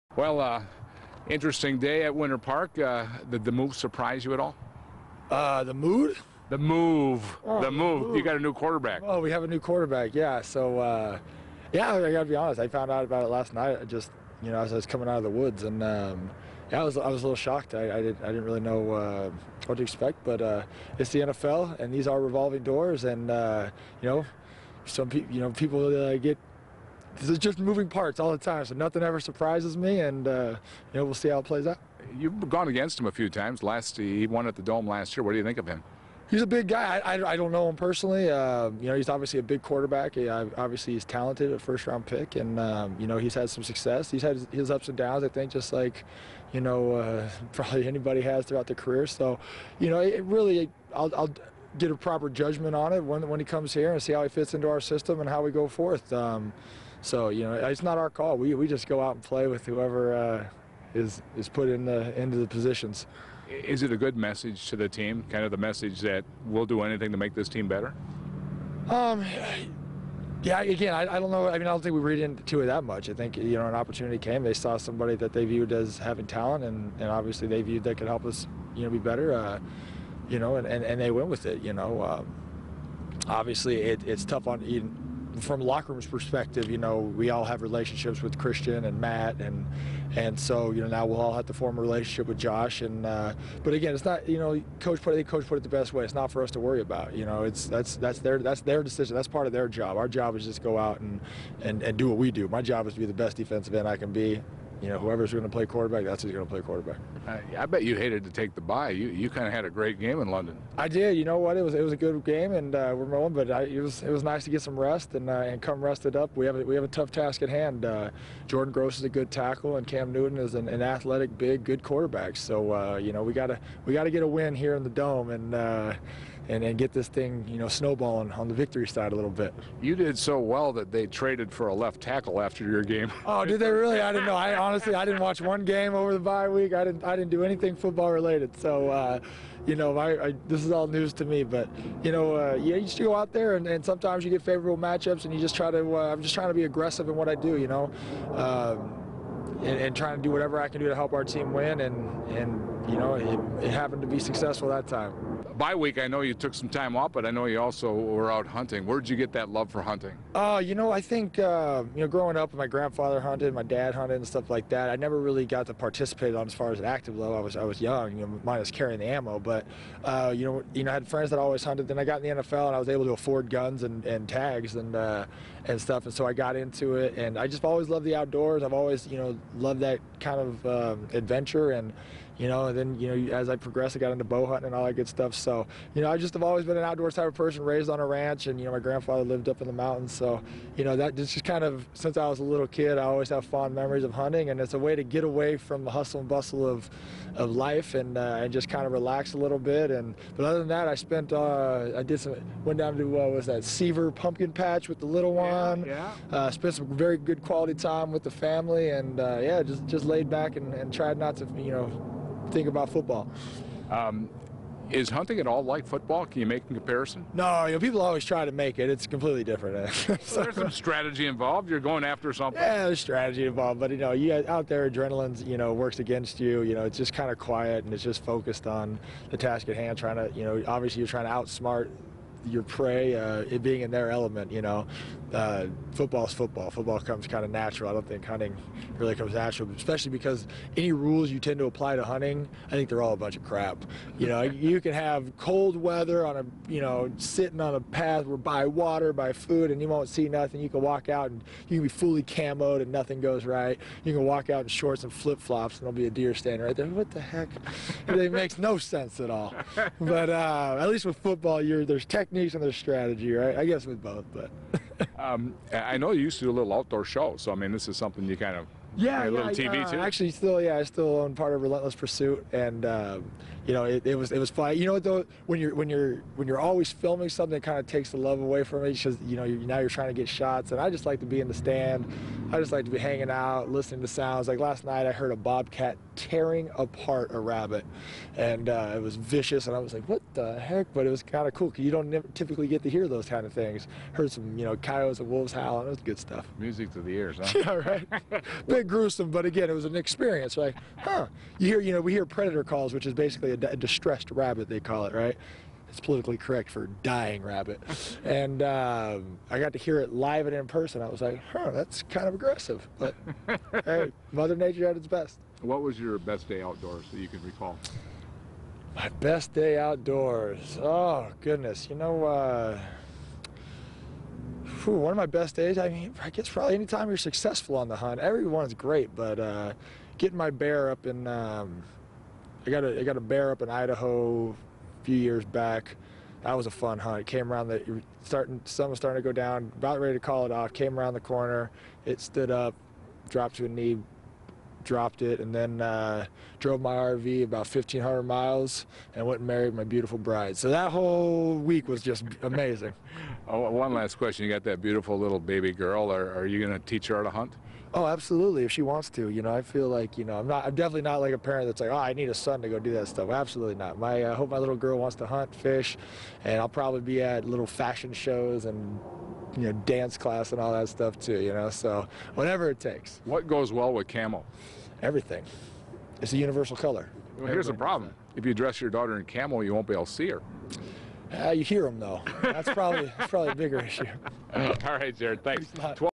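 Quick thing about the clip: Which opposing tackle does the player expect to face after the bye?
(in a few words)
Jordan Gross.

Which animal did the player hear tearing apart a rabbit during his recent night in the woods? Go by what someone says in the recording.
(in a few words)
A bobcat.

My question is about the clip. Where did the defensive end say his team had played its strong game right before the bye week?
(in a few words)
London.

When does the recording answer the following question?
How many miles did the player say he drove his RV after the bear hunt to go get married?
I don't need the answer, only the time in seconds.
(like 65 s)
347 s.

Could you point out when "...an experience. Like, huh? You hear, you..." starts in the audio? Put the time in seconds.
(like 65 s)
299 s.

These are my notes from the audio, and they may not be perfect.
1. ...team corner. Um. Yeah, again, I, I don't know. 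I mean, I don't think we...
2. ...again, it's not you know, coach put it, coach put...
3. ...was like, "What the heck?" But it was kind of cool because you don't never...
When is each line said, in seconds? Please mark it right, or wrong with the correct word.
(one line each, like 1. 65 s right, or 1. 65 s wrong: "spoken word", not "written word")
1. 67 s wrong: "better", not "corner"
2. 93 s right
3. 289 s right.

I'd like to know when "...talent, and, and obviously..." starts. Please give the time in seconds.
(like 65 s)
76 s.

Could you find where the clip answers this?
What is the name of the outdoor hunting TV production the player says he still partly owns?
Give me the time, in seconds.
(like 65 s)
271 s.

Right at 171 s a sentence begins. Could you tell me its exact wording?
Then I got in the NFL and I was able to afford guns and, and tags and, uh, and stuff.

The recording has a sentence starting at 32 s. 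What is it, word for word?
You've gone against him a few times.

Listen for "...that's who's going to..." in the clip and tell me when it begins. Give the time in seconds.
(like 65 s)
106 s.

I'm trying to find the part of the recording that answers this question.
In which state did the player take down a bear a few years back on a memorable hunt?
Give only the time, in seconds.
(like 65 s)
333 s.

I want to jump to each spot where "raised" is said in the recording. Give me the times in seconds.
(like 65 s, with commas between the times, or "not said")
187 s.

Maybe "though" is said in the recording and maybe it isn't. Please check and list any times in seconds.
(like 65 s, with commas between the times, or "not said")
274 s, 381 s.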